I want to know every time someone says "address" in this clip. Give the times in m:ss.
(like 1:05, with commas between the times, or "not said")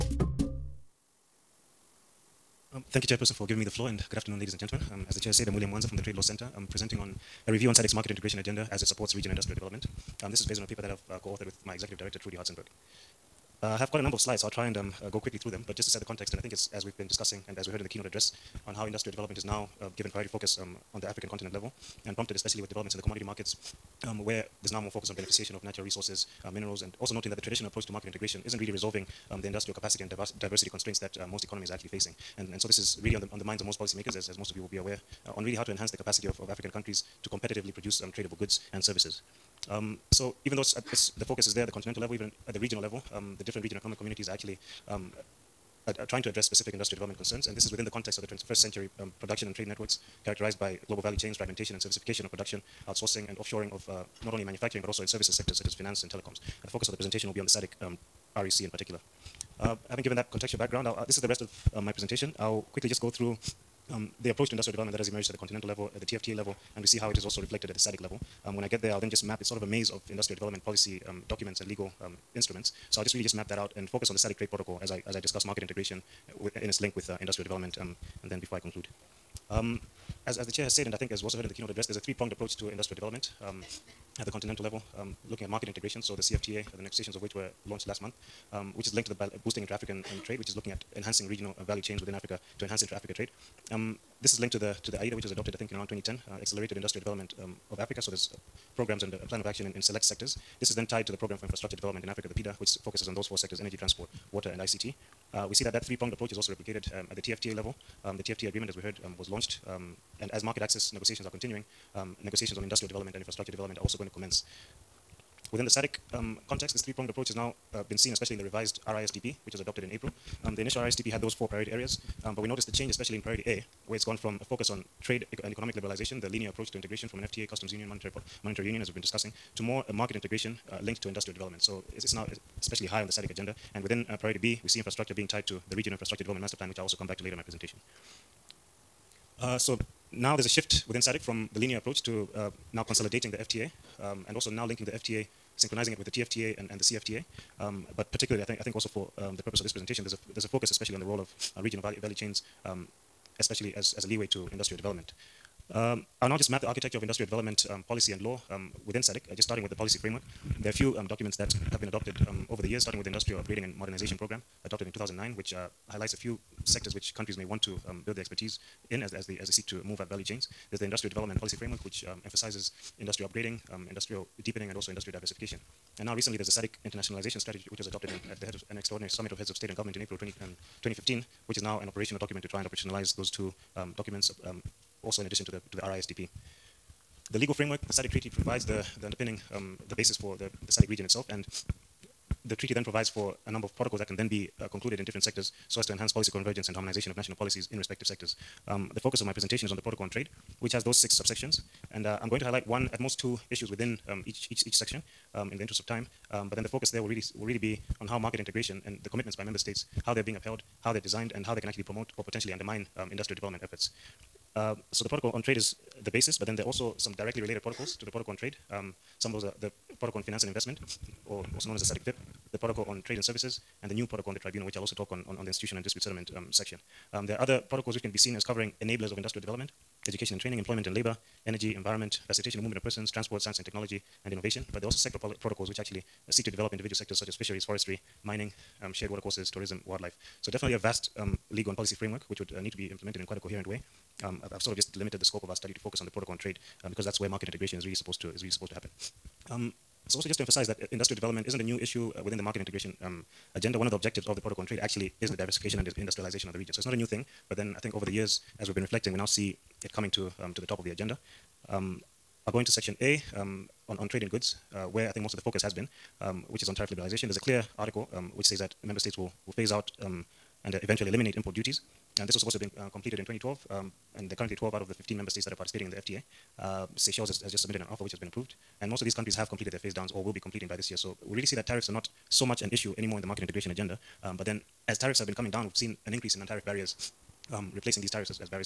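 0:18, 0:46, 1:21.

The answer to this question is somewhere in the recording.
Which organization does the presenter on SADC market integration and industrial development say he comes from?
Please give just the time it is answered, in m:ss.
0:06.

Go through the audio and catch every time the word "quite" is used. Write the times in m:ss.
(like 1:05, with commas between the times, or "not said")
0:13, 4:03.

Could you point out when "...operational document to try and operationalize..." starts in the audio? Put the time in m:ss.
3:01.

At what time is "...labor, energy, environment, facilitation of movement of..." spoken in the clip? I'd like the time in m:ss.
3:50.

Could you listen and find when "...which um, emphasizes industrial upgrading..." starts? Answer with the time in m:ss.
2:51.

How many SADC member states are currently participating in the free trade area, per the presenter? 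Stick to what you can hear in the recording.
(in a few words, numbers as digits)
12.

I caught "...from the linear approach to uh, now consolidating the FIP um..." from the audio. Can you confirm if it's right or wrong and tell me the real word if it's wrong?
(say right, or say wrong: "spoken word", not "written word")
wrong: "FTA", not "FIP".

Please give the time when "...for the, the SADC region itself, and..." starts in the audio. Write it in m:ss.
3:10.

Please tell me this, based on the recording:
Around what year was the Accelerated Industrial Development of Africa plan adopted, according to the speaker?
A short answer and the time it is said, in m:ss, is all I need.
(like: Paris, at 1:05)
2010, at 1:35.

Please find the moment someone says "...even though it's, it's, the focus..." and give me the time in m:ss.
0:40.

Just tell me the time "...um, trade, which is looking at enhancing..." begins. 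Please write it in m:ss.
1:30.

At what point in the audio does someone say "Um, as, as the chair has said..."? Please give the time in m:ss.
1:19.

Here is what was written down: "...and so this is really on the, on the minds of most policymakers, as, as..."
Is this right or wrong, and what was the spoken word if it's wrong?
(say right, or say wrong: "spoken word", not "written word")
right.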